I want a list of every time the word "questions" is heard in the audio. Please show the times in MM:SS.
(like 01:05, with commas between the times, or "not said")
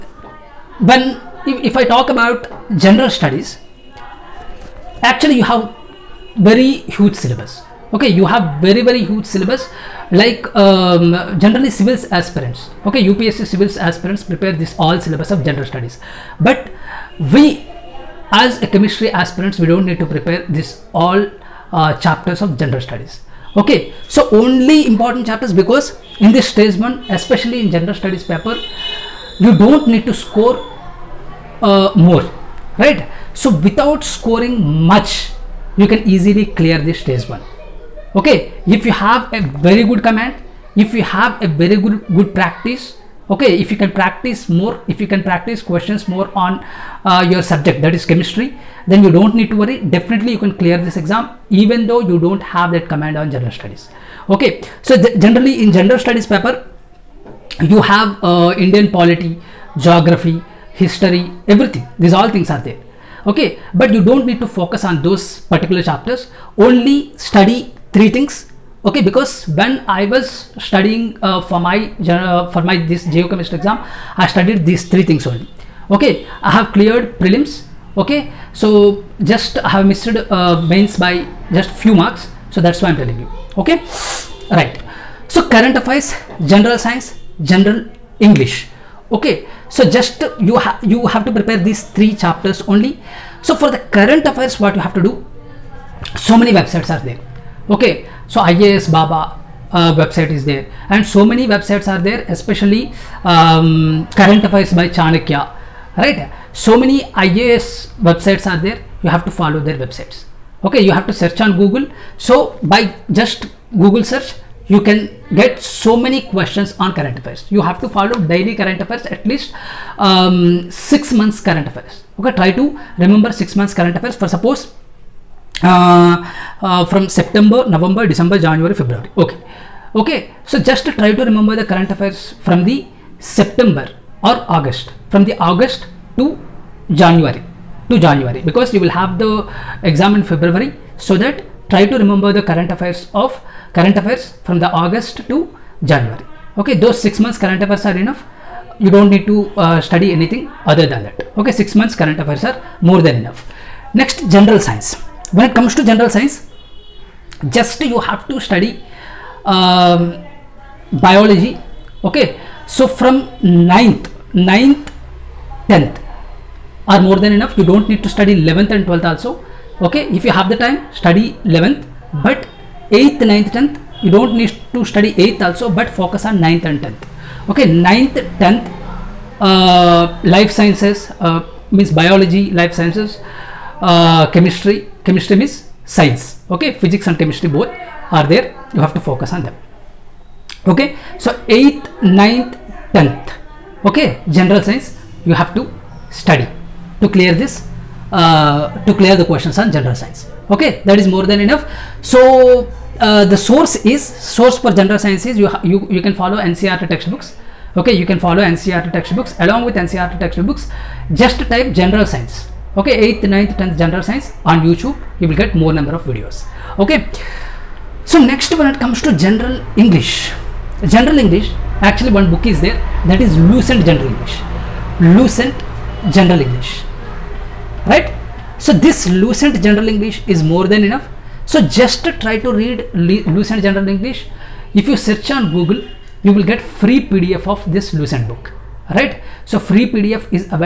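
00:45, 01:56, 03:19.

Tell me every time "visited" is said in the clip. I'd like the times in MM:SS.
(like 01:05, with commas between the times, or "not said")
not said.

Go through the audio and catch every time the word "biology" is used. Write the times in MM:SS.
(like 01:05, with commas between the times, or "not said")
02:40, 03:01.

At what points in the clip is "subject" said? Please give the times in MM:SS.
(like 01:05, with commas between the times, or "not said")
00:47.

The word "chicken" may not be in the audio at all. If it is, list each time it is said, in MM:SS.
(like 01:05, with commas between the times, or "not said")
not said.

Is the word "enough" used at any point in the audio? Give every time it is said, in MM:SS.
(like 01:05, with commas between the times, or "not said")
02:28, 02:33, 02:47, 03:21, 03:50.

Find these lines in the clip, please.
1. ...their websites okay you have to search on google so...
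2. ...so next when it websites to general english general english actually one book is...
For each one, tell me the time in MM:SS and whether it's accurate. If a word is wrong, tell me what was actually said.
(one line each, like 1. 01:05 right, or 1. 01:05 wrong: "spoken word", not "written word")
1. 01:49 right
2. 03:38 wrong: "comes", not "websites".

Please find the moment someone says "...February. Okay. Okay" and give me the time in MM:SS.
02:08.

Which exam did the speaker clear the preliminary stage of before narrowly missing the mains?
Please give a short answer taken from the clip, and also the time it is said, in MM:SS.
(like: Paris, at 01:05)
Geochemistry exam, at 01:13.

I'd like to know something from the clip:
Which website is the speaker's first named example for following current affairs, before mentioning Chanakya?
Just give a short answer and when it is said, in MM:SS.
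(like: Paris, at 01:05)
IAS Baba, at 01:38.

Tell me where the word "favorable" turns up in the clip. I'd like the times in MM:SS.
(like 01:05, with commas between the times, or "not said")
not said.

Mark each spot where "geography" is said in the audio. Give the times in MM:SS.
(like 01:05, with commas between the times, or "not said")
00:59.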